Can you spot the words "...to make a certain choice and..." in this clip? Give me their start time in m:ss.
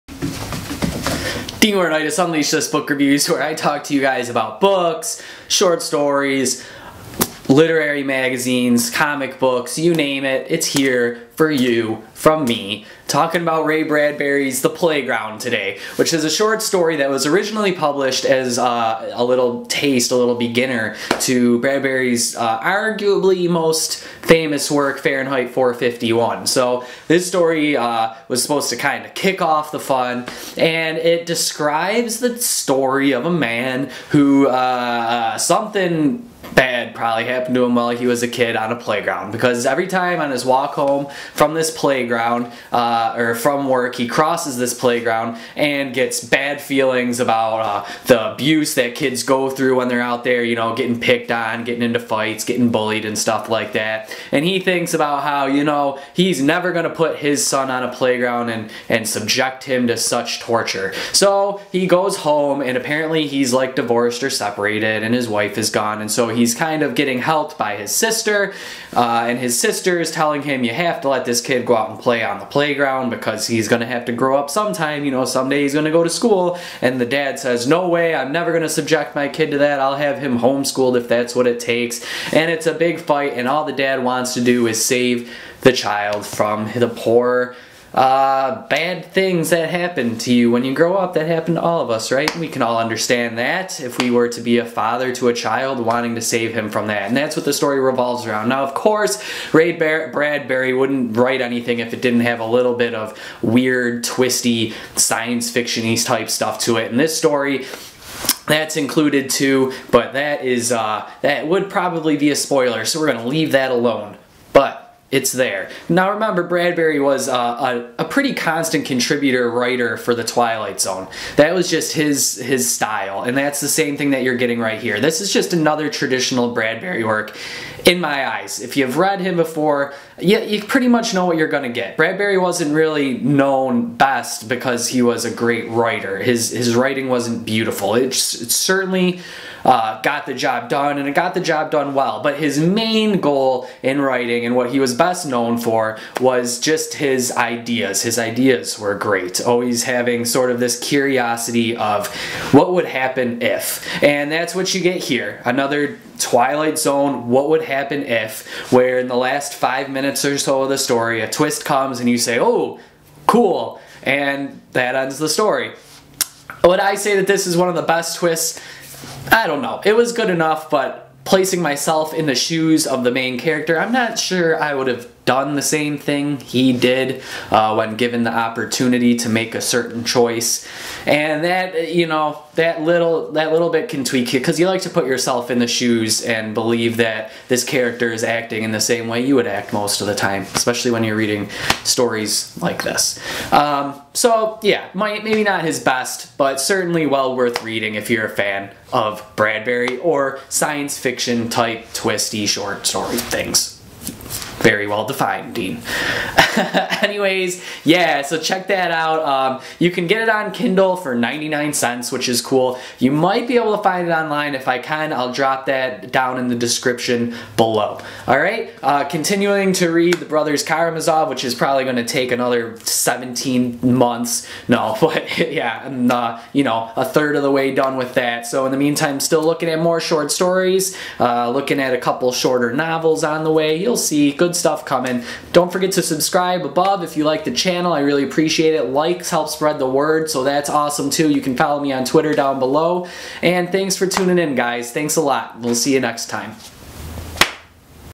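2:59.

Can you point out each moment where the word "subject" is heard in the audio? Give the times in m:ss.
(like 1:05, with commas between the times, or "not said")
0:59, 1:18.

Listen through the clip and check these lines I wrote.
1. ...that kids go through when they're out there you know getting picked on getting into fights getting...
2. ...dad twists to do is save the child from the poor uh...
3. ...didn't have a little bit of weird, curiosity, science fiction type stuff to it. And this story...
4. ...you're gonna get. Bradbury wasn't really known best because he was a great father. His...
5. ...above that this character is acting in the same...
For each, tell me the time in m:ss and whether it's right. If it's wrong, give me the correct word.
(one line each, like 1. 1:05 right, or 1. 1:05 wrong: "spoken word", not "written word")
1. 0:48 right
2. 1:23 wrong: "wants", not "twists"
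3. 1:42 wrong: "twisty", not "curiosity"
4. 2:11 wrong: "writer", not "father"
5. 3:06 wrong: "believe", not "above".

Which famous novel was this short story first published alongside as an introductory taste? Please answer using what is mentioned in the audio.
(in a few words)
Fahrenheit 451.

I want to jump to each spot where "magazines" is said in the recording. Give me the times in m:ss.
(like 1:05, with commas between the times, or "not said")
0:08.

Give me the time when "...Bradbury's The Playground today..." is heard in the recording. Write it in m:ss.
0:13.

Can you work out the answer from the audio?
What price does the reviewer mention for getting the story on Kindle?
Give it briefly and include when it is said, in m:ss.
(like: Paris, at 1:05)
99 cents, at 3:31.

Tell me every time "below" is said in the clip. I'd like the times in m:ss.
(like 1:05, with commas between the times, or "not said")
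3:37, 4:02.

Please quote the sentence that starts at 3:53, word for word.
You'll see good good stuff coming.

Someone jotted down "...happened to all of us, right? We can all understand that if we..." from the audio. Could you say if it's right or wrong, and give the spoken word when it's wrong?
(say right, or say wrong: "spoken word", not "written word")
right.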